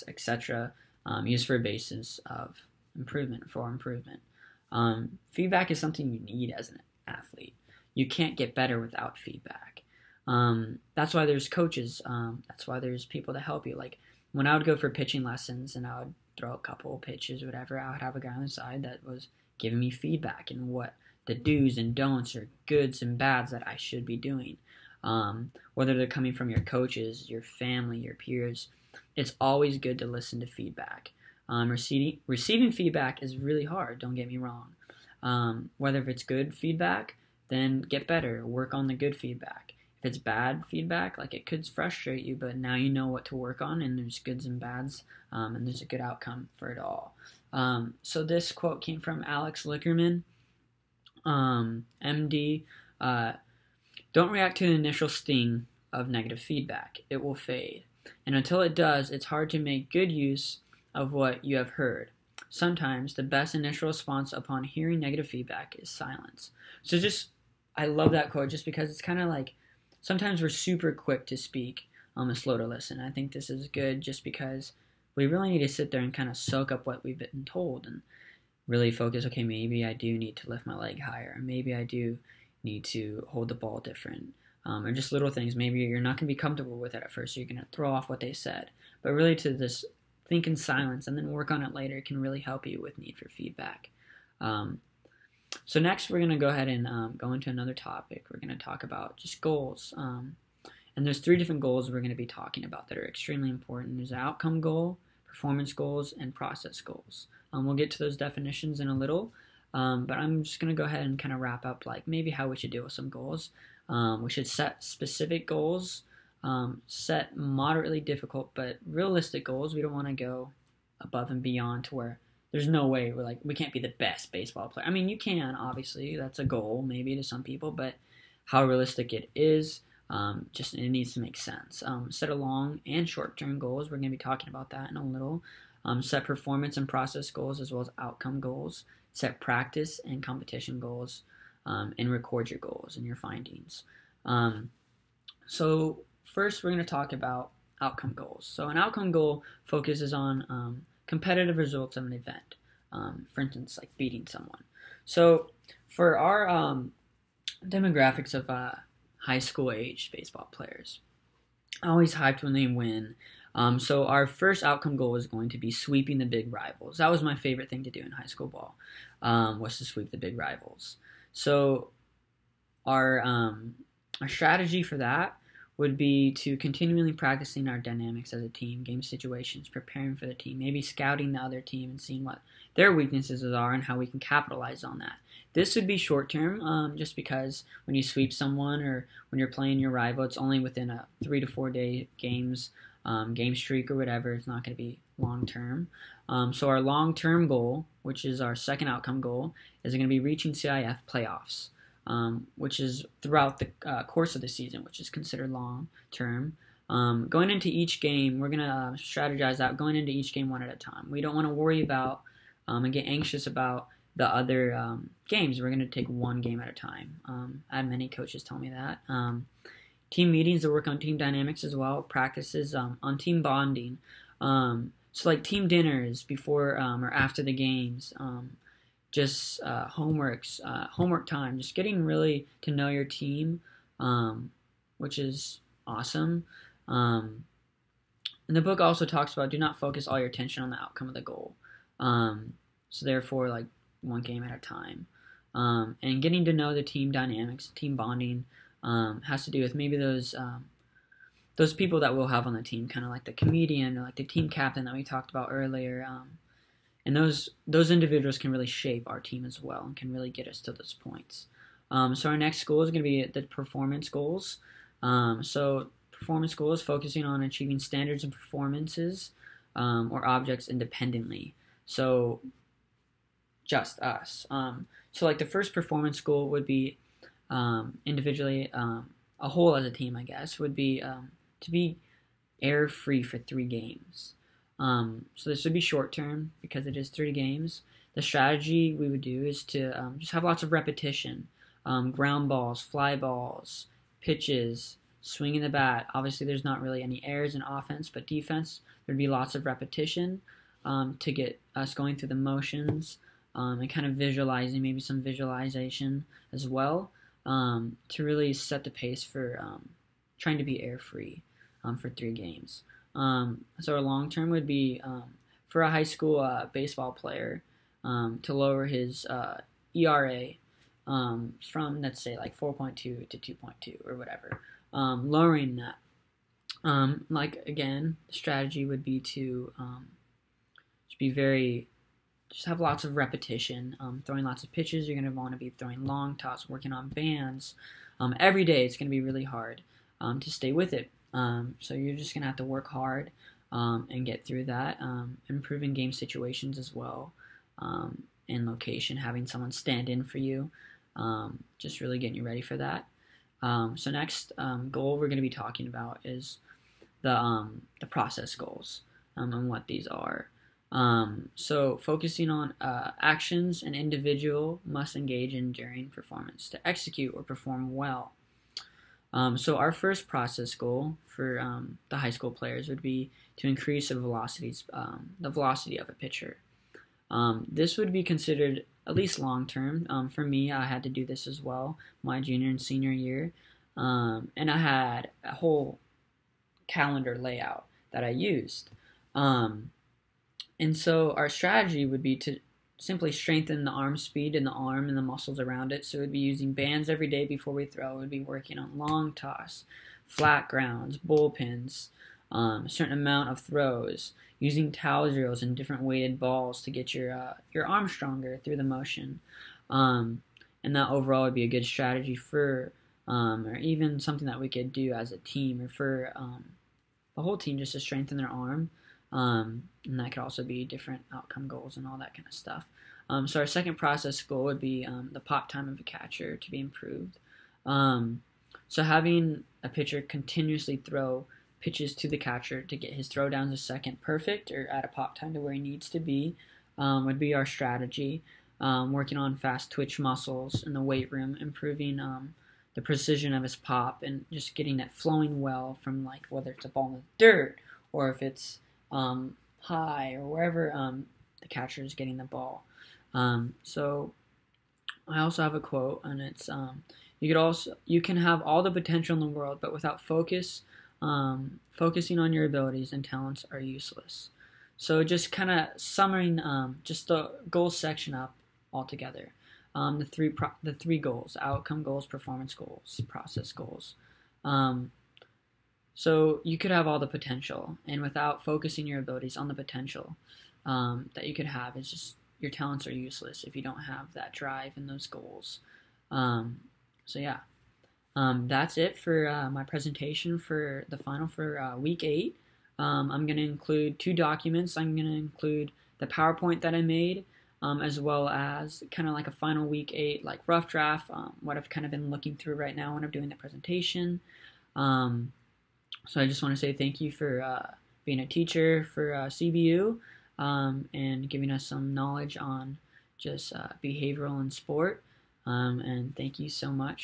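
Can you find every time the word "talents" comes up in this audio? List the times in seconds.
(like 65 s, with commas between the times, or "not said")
463 s, 482 s.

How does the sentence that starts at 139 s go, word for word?
Set practice and competition goals, um, and record your goals and your findings.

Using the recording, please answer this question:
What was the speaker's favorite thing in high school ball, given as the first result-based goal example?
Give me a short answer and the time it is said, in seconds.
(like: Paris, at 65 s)
Sweep the big rivals, at 169 s.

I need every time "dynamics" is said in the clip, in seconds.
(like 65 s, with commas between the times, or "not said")
177 s, 221 s, 247 s.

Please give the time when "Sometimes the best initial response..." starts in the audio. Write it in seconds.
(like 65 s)
62 s.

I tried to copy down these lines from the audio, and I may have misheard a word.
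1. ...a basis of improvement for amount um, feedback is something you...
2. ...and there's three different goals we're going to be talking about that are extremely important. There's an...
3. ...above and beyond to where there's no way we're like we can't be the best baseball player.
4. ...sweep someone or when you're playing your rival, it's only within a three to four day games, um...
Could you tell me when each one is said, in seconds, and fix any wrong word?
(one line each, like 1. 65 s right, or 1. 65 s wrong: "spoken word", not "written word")
1. 1 s wrong: "improvement", not "amount"
2. 100 s right
3. 121 s right
4. 188 s right.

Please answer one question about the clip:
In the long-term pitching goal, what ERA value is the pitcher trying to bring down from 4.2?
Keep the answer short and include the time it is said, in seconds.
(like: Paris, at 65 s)
2.2, at 323 s.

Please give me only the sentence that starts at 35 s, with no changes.
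Um, whether if it's good feedback then get better.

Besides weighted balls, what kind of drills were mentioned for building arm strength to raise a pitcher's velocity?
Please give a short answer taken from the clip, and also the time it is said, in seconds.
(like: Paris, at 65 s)
Towel drills, at 404 s.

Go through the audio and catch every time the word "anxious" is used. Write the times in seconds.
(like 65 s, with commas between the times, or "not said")
213 s.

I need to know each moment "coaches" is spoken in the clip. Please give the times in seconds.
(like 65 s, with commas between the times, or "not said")
11 s, 26 s, 218 s.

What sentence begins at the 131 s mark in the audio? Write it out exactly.
Um, set a long and short-term goals.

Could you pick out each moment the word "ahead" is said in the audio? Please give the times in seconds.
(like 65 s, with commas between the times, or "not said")
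96 s, 110 s.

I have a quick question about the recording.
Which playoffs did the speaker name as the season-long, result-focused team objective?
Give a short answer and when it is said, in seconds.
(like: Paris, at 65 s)
CIF playoffs, at 200 s.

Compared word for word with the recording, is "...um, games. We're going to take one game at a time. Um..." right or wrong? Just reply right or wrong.
right.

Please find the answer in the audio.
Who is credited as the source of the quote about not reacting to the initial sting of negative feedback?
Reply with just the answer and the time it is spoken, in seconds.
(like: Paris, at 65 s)
Alex Lickerman, at 49 s.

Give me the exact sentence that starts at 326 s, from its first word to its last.
Um, like again, the strategy would be to just be very, just have lots of repetition, throwing lots of pitches.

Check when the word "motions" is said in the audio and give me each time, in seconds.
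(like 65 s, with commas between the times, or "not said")
302 s, 408 s.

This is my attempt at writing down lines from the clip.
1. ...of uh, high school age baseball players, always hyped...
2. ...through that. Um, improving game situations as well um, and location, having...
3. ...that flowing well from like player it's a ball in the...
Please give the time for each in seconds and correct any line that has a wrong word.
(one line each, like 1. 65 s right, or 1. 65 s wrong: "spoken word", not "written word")
1. 158 s right
2. 344 s right
3. 444 s wrong: "whether", not "player".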